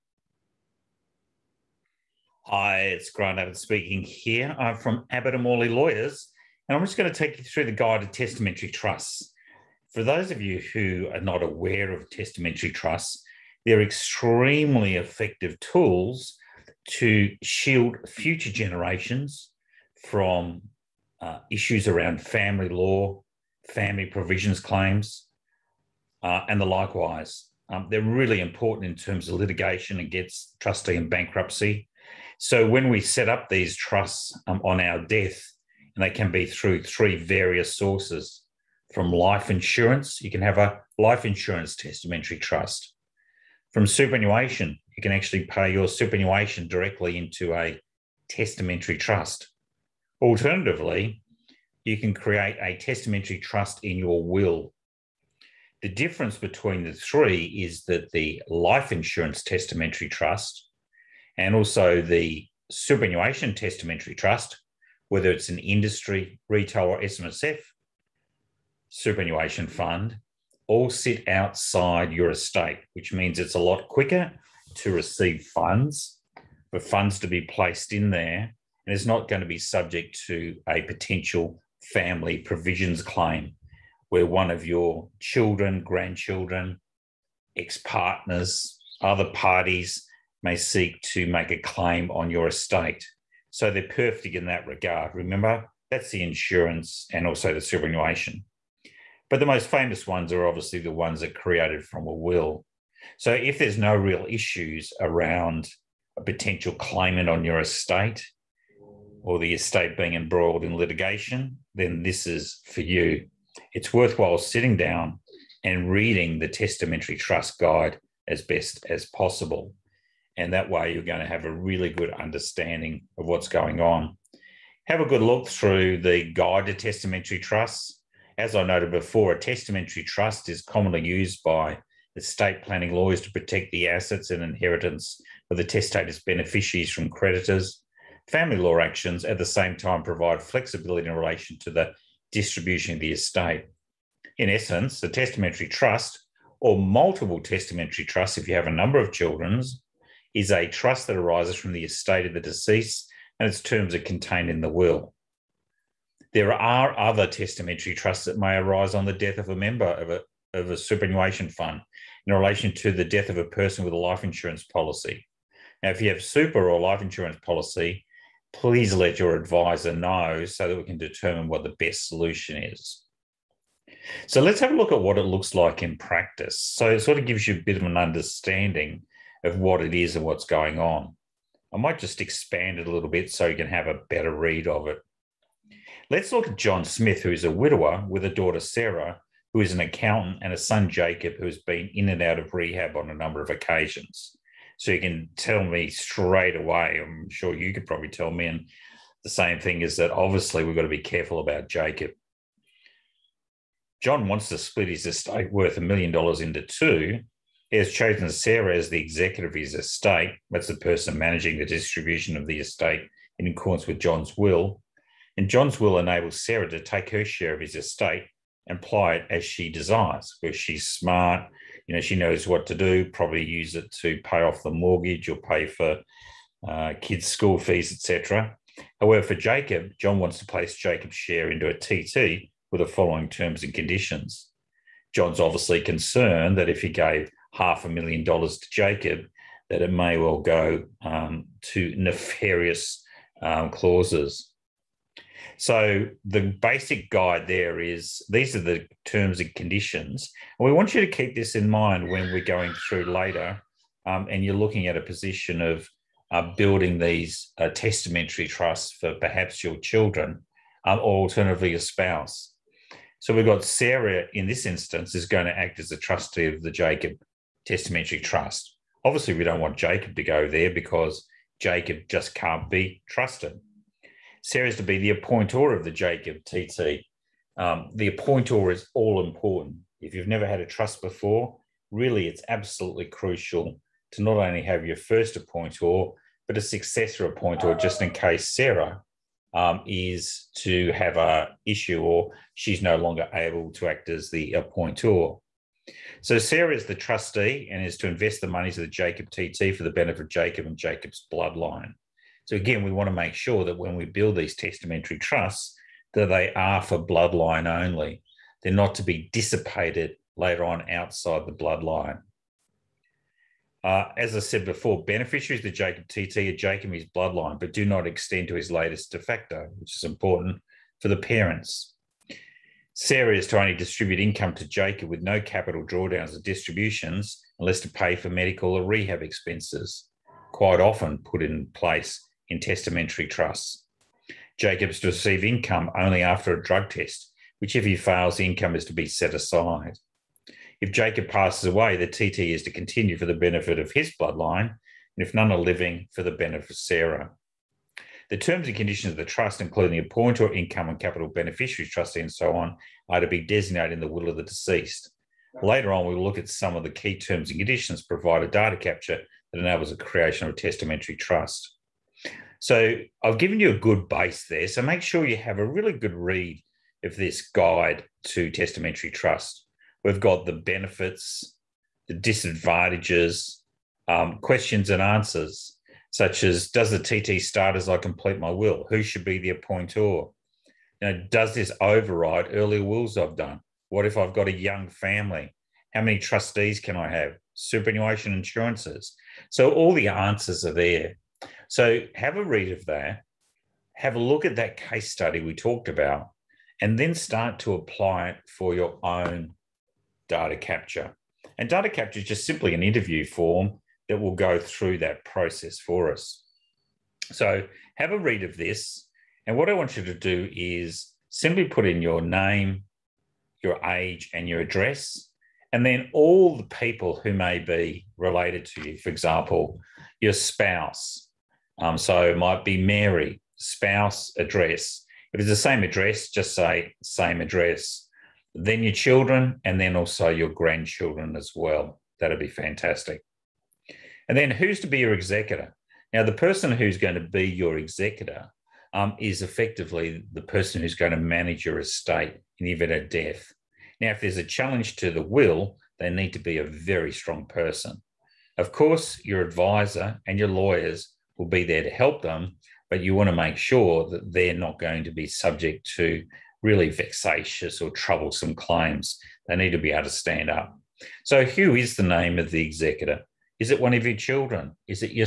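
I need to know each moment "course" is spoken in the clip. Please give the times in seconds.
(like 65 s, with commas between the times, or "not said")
448 s.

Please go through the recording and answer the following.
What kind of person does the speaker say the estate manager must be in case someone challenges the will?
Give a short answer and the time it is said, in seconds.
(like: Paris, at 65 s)
A very strong person, at 446 s.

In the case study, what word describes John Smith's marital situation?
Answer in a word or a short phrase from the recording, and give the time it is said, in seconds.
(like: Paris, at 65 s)
Widower, at 187 s.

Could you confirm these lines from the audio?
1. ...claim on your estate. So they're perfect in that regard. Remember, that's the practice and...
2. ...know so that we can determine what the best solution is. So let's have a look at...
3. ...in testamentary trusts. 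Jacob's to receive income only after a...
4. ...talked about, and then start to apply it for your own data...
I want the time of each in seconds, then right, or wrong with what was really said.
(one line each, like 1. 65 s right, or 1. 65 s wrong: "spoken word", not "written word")
1. 91 s wrong: "insurance", not "practice"
2. 169 s right
3. 332 s right
4. 395 s right.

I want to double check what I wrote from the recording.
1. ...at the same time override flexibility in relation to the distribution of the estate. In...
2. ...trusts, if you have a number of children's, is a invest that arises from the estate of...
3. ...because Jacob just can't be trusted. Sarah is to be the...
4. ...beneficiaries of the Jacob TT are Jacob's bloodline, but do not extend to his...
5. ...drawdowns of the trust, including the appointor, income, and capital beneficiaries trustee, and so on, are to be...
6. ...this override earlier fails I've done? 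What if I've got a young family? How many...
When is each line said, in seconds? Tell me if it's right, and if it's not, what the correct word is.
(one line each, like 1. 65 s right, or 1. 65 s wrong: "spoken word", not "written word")
1. 139 s wrong: "provide", not "override"
2. 148 s wrong: "trust", not "invest"
3. 270 s right
4. 315 s right
5. 348 s wrong: "conditions", not "drawdowns"
6. 381 s wrong: "wills", not "fails".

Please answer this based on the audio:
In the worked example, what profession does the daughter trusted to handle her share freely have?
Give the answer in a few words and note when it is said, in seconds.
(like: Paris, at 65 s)
Accountant, at 189 s.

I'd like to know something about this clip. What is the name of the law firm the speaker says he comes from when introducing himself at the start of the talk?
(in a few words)
Abbott and Morley Lawyers.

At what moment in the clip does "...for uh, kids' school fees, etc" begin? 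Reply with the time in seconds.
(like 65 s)
225 s.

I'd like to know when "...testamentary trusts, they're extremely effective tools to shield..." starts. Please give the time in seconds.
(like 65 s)
12 s.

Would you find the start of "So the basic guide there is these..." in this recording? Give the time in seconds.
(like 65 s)
245 s.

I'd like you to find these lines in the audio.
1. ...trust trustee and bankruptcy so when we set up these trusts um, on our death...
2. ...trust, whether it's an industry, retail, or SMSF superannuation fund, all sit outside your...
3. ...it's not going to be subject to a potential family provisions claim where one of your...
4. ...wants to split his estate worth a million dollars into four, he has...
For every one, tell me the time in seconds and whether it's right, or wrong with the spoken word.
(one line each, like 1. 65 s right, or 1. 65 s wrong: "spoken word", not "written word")
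1. 29 s wrong: "against", not "trust"
2. 64 s right
3. 78 s right
4. 204 s wrong: "two", not "four".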